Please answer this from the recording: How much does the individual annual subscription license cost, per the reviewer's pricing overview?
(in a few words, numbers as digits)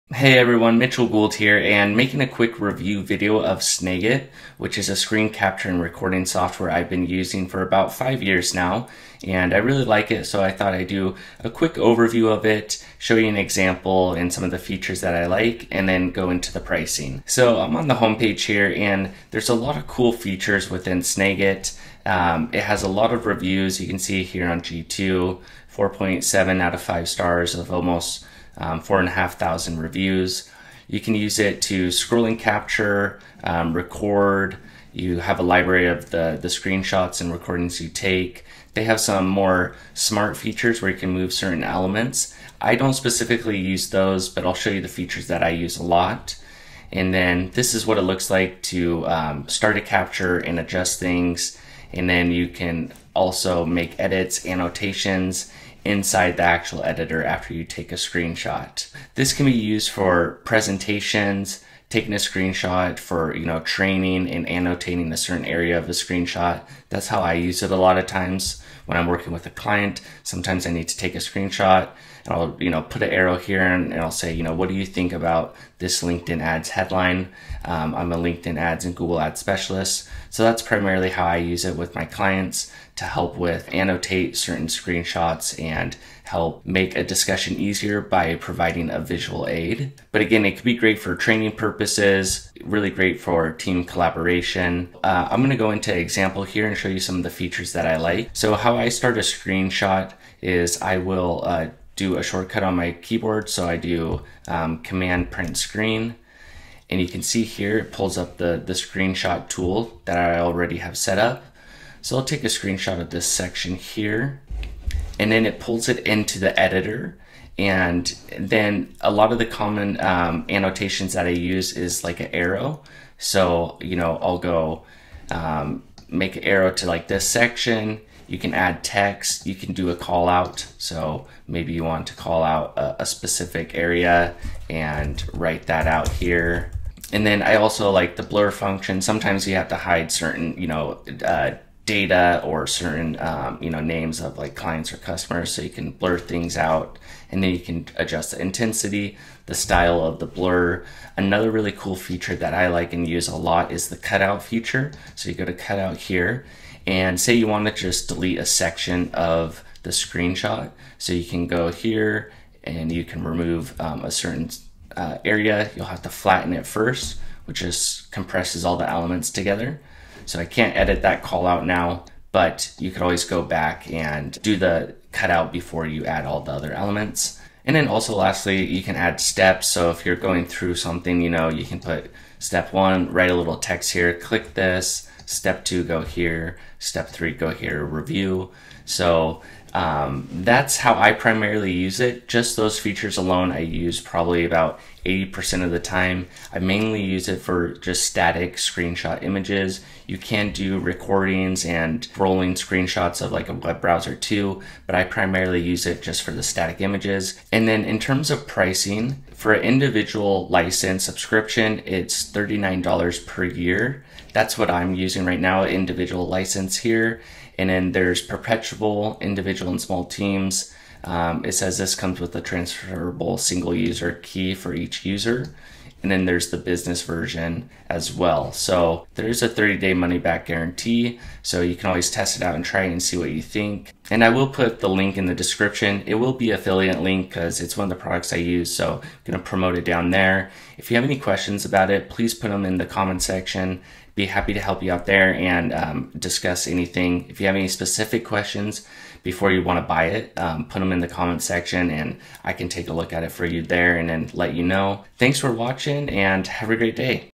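$39 per year.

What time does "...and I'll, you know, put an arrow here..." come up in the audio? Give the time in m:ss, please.
1:12.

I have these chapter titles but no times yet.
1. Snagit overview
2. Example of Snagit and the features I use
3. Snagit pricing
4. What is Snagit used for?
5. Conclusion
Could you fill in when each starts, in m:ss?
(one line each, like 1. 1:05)
1. 0:17
2. 1:34
3. 3:28
4. 1:00
5. 3:54.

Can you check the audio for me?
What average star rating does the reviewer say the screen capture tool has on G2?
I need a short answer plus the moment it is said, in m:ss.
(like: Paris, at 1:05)
4.7, at 0:25.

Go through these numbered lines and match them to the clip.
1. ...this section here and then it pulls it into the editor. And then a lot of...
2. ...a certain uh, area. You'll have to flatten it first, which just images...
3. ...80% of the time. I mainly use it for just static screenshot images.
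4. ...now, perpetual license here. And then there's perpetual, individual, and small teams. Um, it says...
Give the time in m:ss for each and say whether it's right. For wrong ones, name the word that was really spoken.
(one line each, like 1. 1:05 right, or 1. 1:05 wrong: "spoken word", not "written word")
1. 1:53 right
2. 2:44 wrong: "compresses", not "images"
3. 3:15 right
4. 3:35 wrong: "individual", not "perpetual".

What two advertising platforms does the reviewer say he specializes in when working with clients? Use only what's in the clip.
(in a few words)
LinkedIn ads and Google ads.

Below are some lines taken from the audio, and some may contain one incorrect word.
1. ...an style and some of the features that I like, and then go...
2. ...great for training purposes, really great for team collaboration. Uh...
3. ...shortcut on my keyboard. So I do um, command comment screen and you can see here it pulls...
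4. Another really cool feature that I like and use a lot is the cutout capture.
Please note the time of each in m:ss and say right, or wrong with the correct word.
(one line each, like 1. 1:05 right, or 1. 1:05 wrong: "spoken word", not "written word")
1. 0:13 wrong: "example", not "style"
2. 1:30 right
3. 1:42 wrong: "print", not "comment"
4. 2:31 wrong: "feature", not "capture".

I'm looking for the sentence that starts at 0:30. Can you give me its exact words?
You can use it to scrolling capture, um, record.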